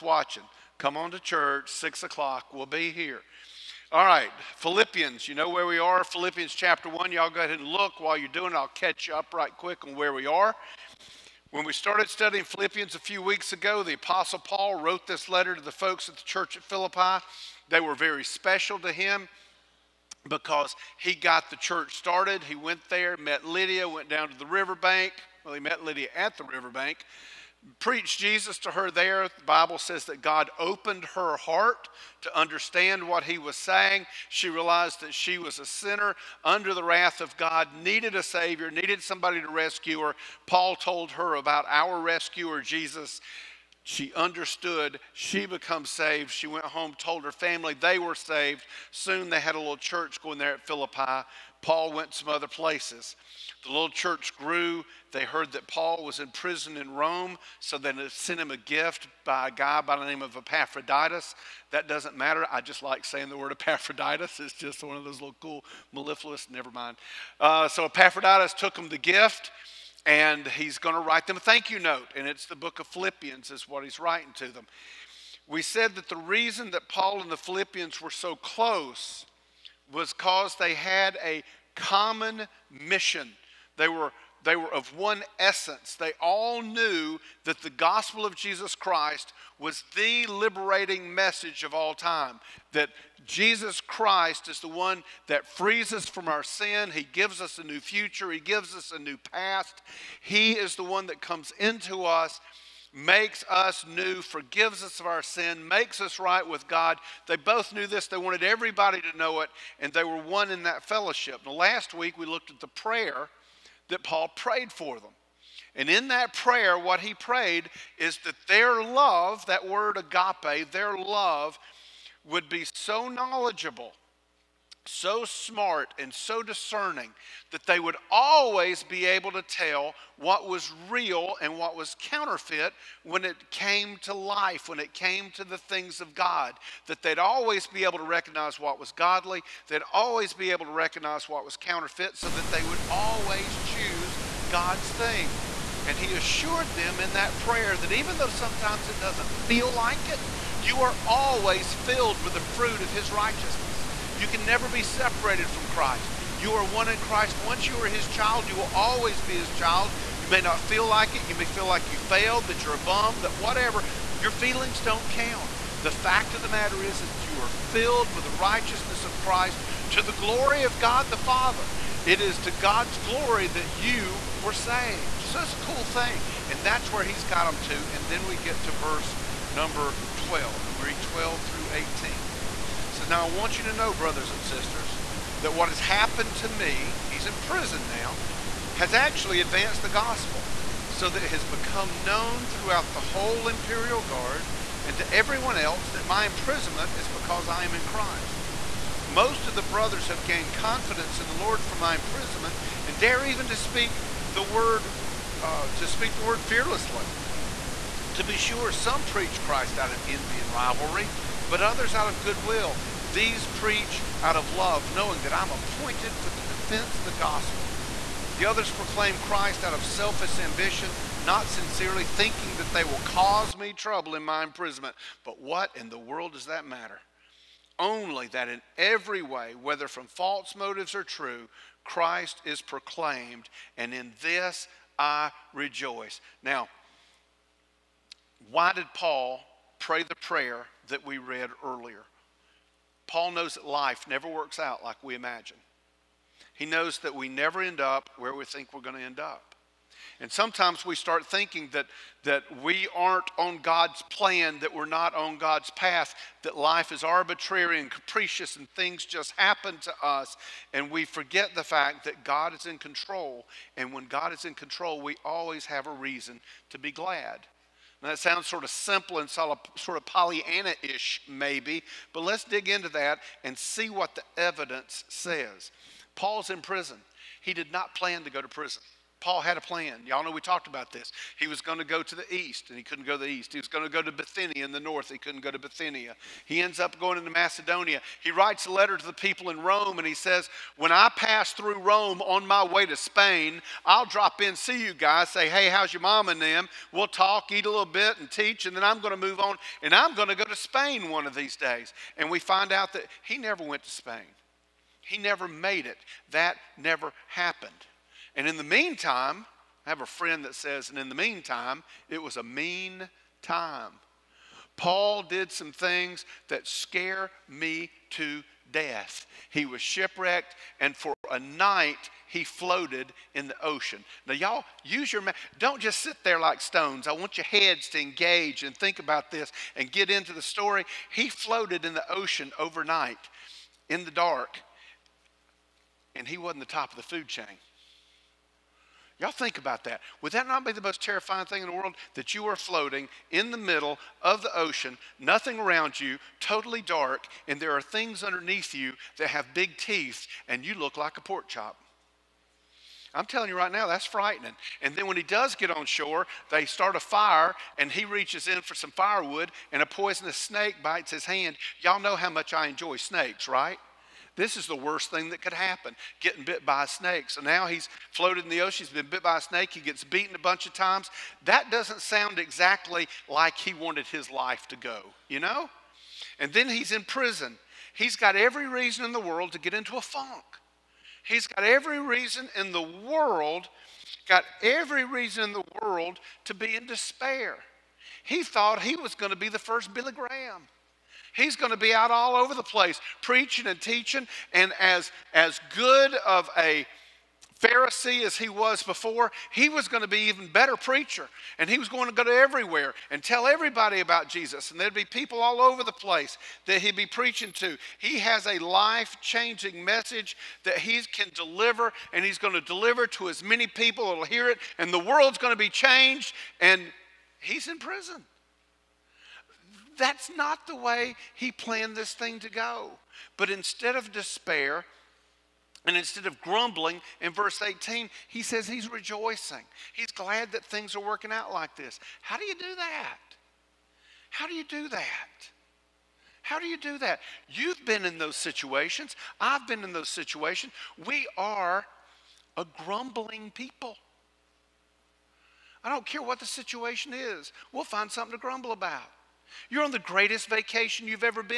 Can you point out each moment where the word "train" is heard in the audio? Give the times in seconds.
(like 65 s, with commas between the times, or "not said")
not said.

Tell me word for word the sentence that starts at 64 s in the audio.
It's just one of those little cool mellifluous, never mind.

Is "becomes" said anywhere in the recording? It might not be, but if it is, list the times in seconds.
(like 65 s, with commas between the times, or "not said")
45 s, 191 s.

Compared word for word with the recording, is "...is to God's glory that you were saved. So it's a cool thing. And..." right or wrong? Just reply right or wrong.
right.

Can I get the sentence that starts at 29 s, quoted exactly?
The Bible says that God opened her heart to understand what he was saying.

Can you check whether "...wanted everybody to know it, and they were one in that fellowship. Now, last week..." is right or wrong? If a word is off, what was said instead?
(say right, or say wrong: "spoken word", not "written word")
right.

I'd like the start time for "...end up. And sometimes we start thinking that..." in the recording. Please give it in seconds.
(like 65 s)
249 s.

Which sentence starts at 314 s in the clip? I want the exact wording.
Paul did some things that scare me to death.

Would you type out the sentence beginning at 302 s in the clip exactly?
And we find out that he never went to Spain.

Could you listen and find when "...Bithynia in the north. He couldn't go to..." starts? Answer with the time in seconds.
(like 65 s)
284 s.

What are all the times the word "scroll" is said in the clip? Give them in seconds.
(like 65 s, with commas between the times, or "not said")
not said.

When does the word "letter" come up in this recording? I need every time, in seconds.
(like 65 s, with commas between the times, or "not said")
15 s, 288 s.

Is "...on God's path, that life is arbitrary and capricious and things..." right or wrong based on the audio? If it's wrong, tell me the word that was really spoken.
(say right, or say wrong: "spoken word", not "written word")
right.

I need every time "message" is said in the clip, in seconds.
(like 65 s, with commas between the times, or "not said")
91 s, 409 s.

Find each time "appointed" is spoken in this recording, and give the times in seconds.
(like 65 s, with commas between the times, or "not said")
215 s.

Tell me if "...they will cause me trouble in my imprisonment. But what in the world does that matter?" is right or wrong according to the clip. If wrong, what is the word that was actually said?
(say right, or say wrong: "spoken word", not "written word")
right.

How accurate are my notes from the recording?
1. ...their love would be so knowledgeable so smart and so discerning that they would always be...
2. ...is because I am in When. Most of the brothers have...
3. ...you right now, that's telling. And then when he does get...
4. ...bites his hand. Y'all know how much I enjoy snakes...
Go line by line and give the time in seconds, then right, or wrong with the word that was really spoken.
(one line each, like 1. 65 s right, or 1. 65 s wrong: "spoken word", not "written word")
1. 120 s right
2. 196 s wrong: "Christ", not "When"
3. 353 s wrong: "frightening", not "telling"
4. 360 s right.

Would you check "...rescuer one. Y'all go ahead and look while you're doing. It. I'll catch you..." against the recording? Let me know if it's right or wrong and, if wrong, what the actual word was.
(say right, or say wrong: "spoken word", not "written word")
wrong: "chapter", not "rescuer".